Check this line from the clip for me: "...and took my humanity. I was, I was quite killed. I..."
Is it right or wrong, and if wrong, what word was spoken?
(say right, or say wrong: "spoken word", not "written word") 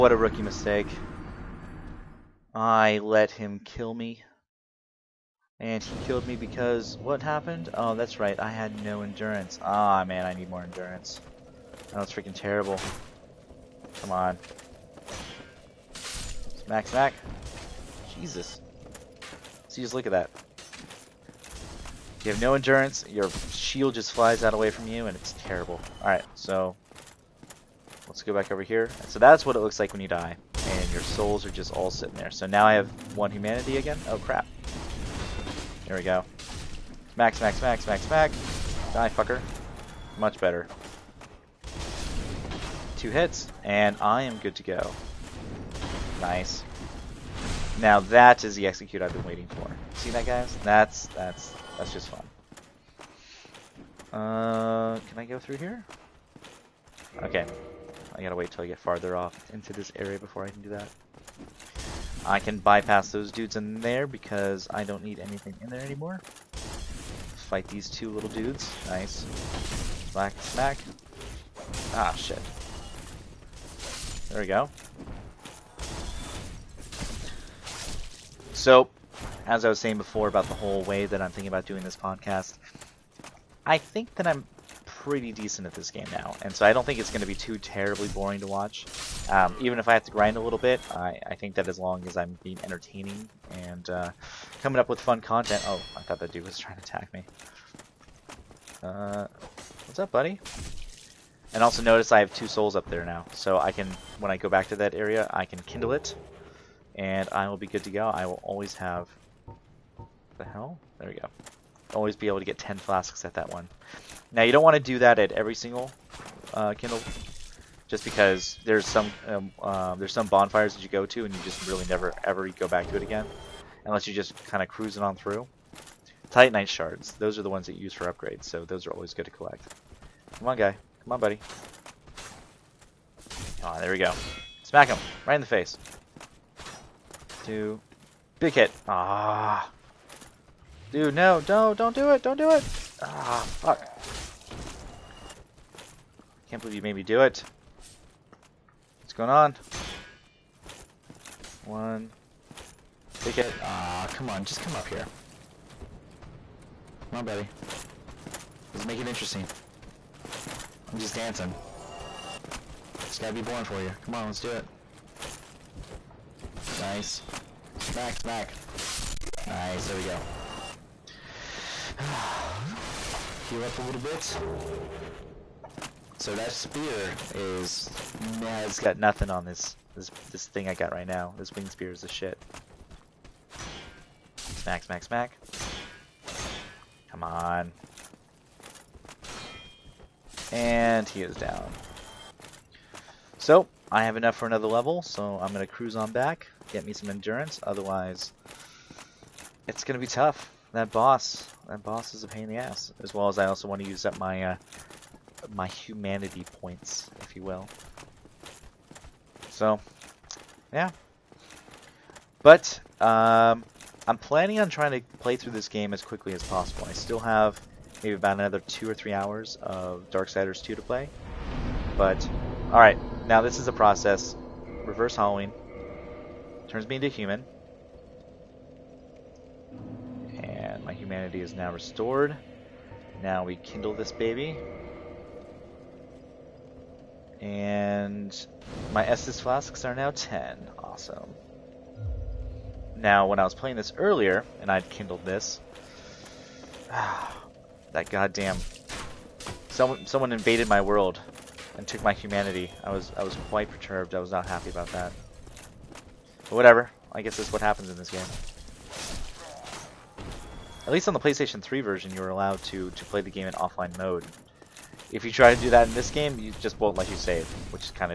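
wrong: "perturbed", not "killed".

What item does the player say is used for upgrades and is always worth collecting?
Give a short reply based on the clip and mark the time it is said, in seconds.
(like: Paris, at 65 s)
Titanite shards, at 126 s.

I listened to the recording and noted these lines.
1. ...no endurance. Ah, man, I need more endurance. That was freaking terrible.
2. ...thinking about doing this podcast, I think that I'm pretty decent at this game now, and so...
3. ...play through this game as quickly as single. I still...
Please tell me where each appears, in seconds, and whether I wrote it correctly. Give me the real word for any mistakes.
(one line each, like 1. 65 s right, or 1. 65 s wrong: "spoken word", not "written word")
1. 8 s right
2. 81 s right
3. 215 s wrong: "possible", not "single".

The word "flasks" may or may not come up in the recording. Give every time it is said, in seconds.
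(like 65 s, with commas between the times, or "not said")
112 s, 239 s.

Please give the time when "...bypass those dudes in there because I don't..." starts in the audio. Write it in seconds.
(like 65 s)
62 s.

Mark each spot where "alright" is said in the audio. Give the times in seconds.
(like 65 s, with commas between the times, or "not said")
222 s.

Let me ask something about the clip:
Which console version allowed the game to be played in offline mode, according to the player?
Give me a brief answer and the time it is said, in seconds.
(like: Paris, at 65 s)
PlayStation 3, at 261 s.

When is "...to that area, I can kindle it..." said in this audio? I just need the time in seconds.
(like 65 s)
104 s.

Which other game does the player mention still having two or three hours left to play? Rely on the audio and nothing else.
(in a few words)
Darksiders 2.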